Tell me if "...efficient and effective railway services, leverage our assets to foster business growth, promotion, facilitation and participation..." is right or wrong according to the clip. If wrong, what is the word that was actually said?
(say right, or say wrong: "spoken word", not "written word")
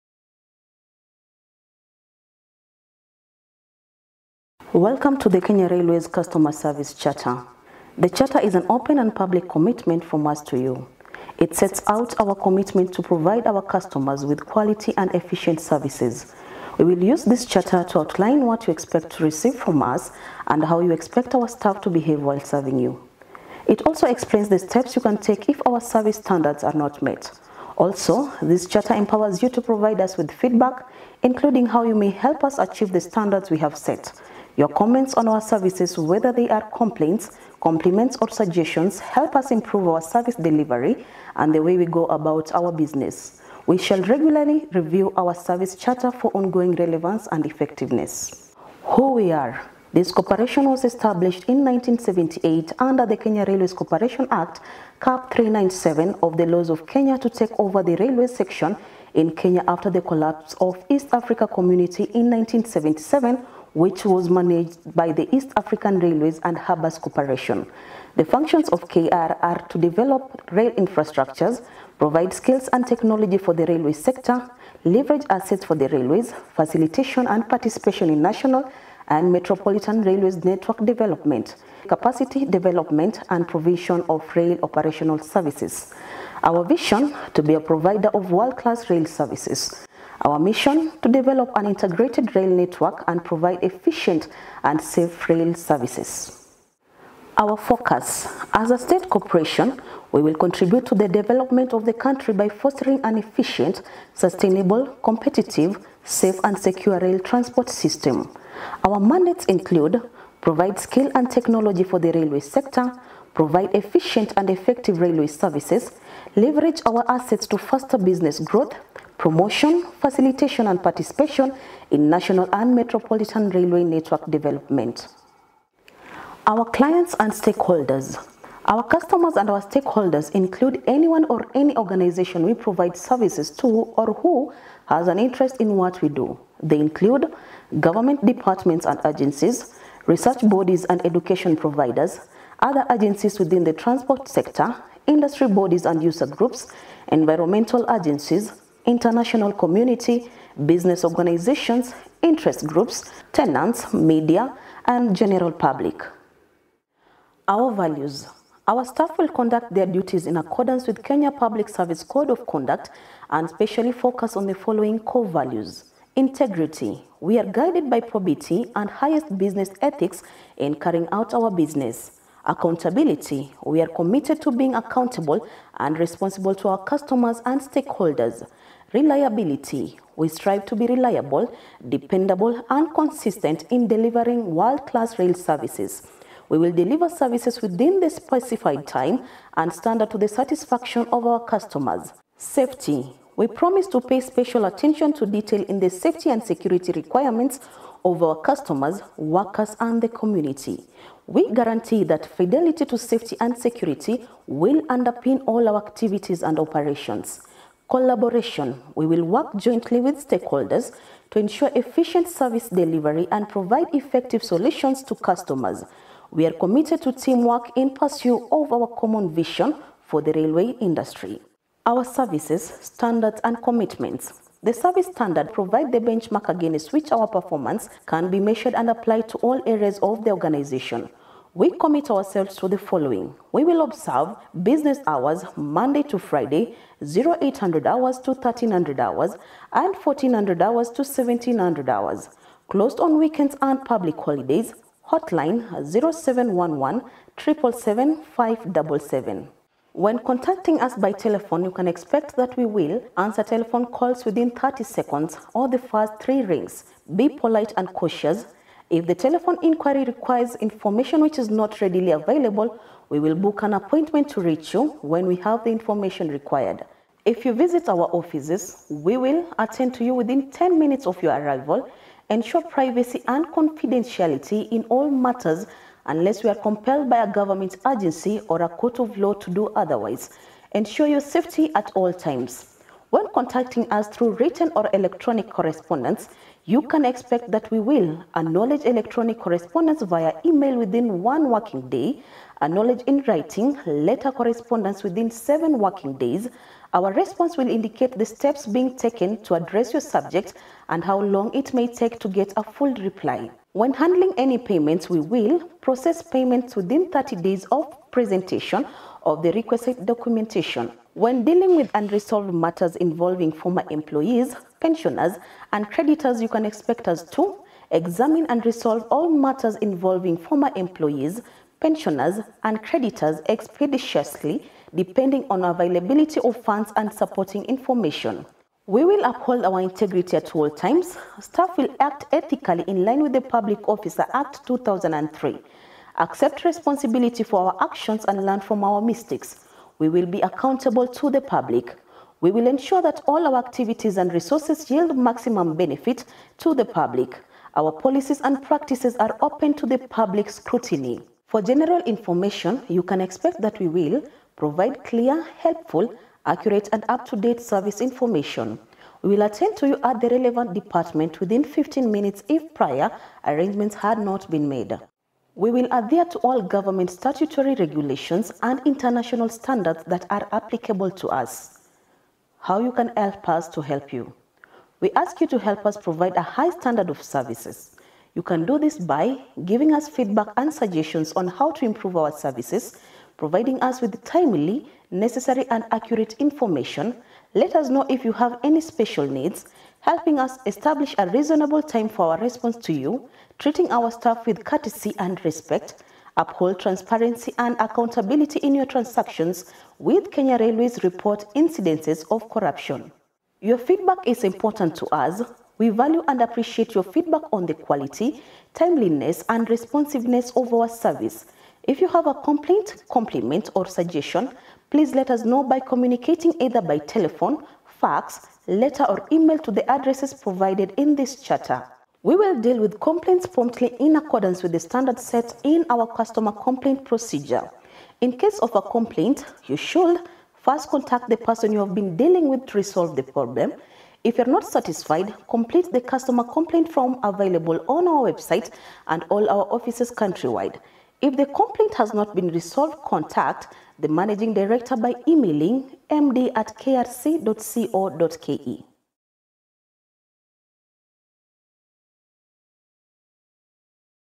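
right.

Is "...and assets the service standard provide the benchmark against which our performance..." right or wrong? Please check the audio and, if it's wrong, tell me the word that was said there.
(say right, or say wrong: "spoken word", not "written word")
wrong: "commitments", not "assets".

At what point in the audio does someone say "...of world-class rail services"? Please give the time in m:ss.
1:28.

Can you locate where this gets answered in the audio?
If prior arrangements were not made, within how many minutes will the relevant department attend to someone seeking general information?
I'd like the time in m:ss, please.
6:01.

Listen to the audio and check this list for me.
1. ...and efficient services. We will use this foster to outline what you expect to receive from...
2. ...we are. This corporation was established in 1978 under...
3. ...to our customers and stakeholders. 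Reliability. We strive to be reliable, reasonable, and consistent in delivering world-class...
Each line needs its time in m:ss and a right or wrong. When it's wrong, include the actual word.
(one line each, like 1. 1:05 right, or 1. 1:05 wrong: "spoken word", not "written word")
1. 0:14 wrong: "charter", not "foster"
2. 0:49 right
3. 2:56 wrong: "dependable", not "reasonable".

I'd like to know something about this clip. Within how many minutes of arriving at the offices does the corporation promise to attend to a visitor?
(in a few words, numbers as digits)
10.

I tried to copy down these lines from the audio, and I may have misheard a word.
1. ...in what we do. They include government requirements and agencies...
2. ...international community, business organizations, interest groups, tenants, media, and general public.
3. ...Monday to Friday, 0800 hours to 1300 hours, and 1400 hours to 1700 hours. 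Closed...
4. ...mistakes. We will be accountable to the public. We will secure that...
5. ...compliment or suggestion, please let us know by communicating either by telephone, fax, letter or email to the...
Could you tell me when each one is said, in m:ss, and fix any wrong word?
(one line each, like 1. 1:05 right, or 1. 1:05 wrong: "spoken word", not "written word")
1. 2:15 wrong: "departments", not "requirements"
2. 2:28 right
3. 3:55 right
4. 5:39 wrong: "ensure", not "secure"
5. 6:53 right.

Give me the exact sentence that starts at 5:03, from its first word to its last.
When handling any payments, we will process payments within 30 days of presentation of the requisite documentation.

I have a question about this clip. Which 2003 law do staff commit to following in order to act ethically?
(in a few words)
Public Officer Act.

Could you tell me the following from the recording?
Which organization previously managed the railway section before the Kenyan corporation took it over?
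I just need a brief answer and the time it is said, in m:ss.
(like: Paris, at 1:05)
East African Railways and Harbours Corporation, at 1:05.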